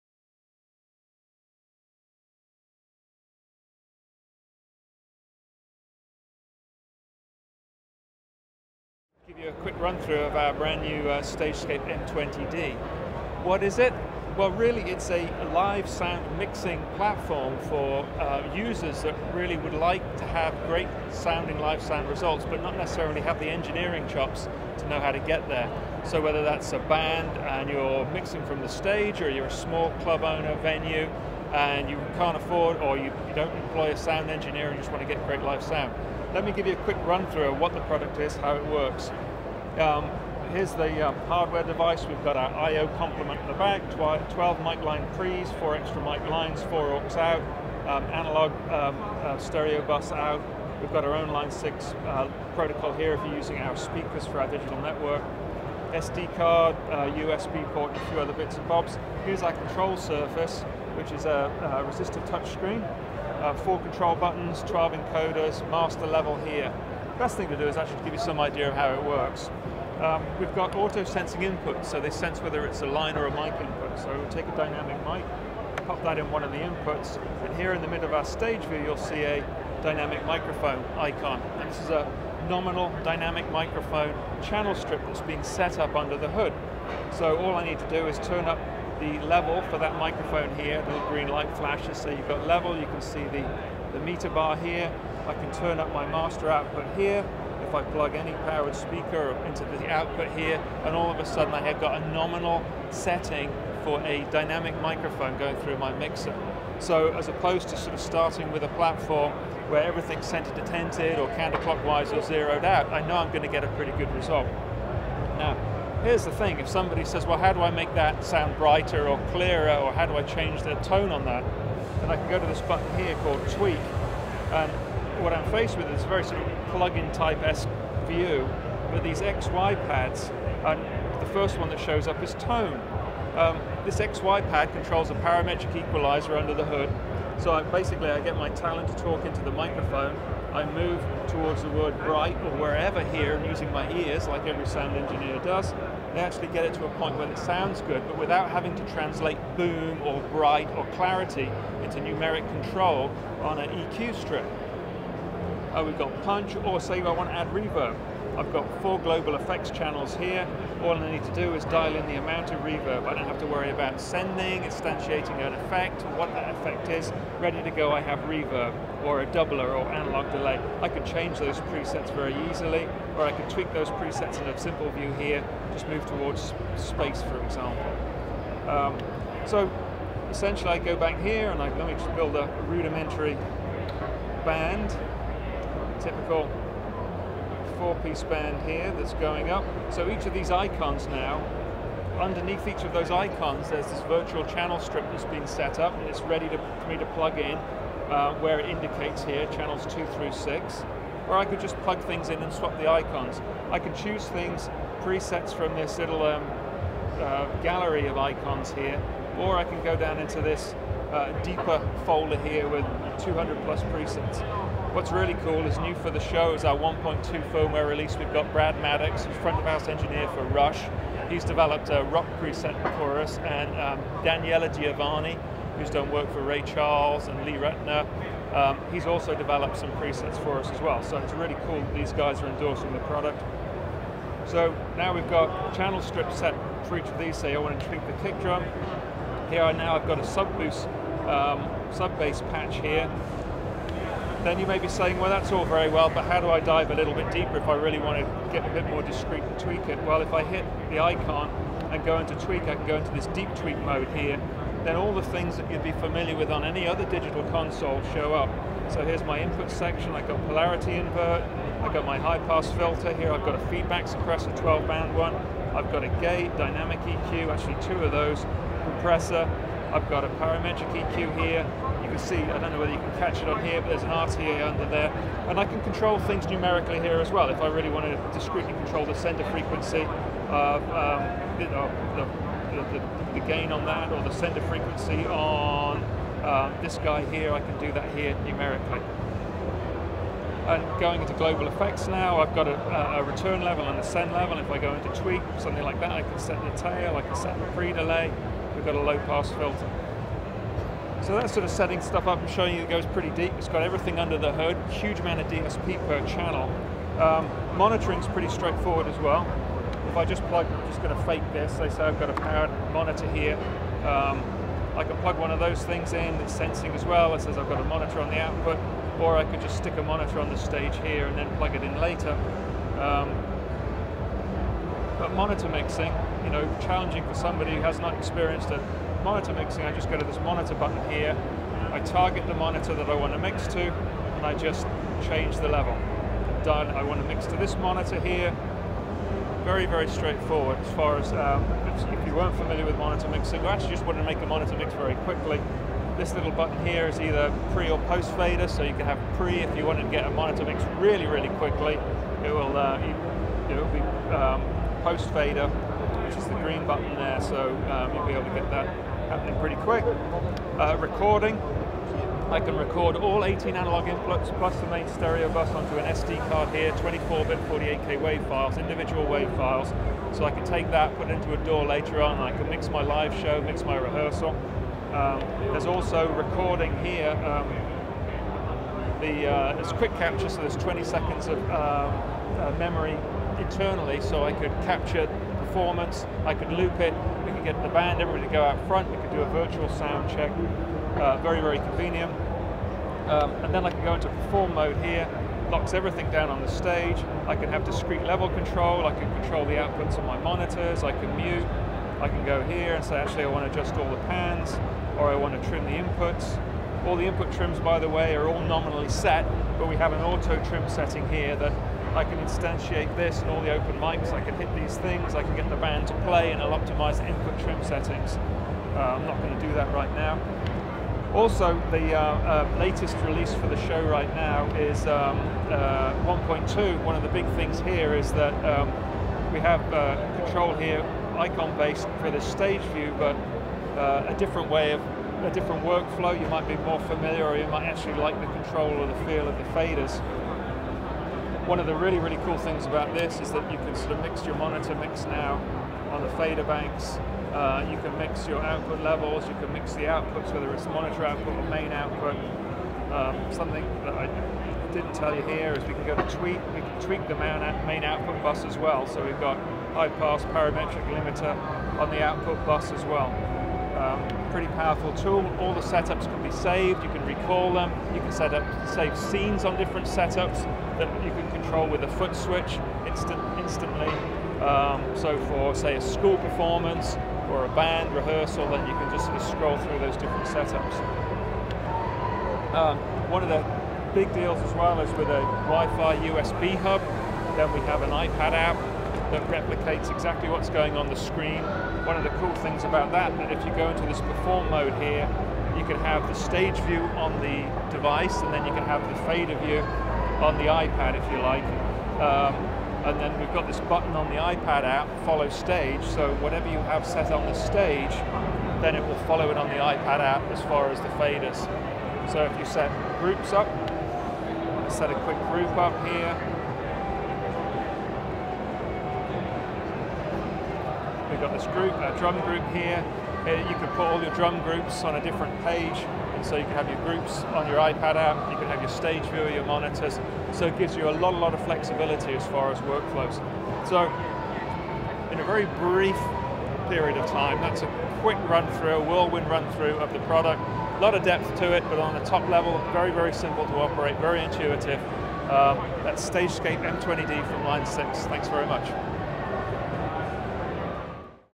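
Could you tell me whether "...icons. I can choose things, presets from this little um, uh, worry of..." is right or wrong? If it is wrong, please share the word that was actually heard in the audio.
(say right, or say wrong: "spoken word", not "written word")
wrong: "gallery", not "worry".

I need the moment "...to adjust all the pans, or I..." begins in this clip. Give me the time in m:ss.
6:43.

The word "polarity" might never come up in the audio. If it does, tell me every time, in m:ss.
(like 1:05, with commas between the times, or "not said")
4:20.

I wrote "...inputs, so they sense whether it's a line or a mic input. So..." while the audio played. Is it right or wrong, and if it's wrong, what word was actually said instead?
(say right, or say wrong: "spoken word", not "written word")
right.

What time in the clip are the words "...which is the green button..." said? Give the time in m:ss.
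5:56.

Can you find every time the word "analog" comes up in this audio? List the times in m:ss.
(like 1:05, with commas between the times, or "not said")
0:48, 2:49, 6:03.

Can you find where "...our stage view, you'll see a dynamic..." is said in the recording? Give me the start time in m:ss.
1:18.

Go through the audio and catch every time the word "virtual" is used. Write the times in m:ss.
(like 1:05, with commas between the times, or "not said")
3:14, 6:29.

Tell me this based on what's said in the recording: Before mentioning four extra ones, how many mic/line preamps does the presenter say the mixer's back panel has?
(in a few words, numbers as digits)
12.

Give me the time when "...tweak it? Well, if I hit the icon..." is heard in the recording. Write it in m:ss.
4:09.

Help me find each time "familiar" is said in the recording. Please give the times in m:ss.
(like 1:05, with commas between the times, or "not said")
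4:15, 5:42, 7:16.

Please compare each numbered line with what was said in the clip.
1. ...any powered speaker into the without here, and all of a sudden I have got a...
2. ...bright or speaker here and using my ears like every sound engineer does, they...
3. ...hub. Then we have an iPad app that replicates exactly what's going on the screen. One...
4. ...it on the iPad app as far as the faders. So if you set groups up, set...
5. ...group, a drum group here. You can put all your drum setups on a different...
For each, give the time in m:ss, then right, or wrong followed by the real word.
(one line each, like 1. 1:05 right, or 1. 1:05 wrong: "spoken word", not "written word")
1. 1:38 wrong: "output", not "without"
2. 2:21 wrong: "wherever", not "speaker"
3. 8:06 right
4. 8:29 right
5. 8:41 wrong: "groups", not "setups".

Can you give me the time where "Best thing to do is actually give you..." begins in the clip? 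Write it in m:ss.
1:07.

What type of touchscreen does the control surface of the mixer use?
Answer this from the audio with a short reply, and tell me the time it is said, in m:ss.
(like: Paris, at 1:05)
Resistive, at 1:01.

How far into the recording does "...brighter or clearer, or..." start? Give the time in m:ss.
1:58.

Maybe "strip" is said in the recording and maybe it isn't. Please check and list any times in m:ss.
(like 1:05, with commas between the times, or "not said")
1:24, 2:34, 3:14, 3:56.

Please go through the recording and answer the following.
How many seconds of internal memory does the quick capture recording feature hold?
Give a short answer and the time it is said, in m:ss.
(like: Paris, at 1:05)
20, at 6:20.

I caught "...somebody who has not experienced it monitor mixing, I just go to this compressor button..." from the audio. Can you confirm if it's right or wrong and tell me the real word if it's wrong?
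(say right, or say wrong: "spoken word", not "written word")
wrong: "monitor", not "compressor".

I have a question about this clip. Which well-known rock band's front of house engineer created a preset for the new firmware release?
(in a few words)
Rush.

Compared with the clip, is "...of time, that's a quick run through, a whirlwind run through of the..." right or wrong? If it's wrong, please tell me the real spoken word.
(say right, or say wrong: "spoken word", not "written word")
right.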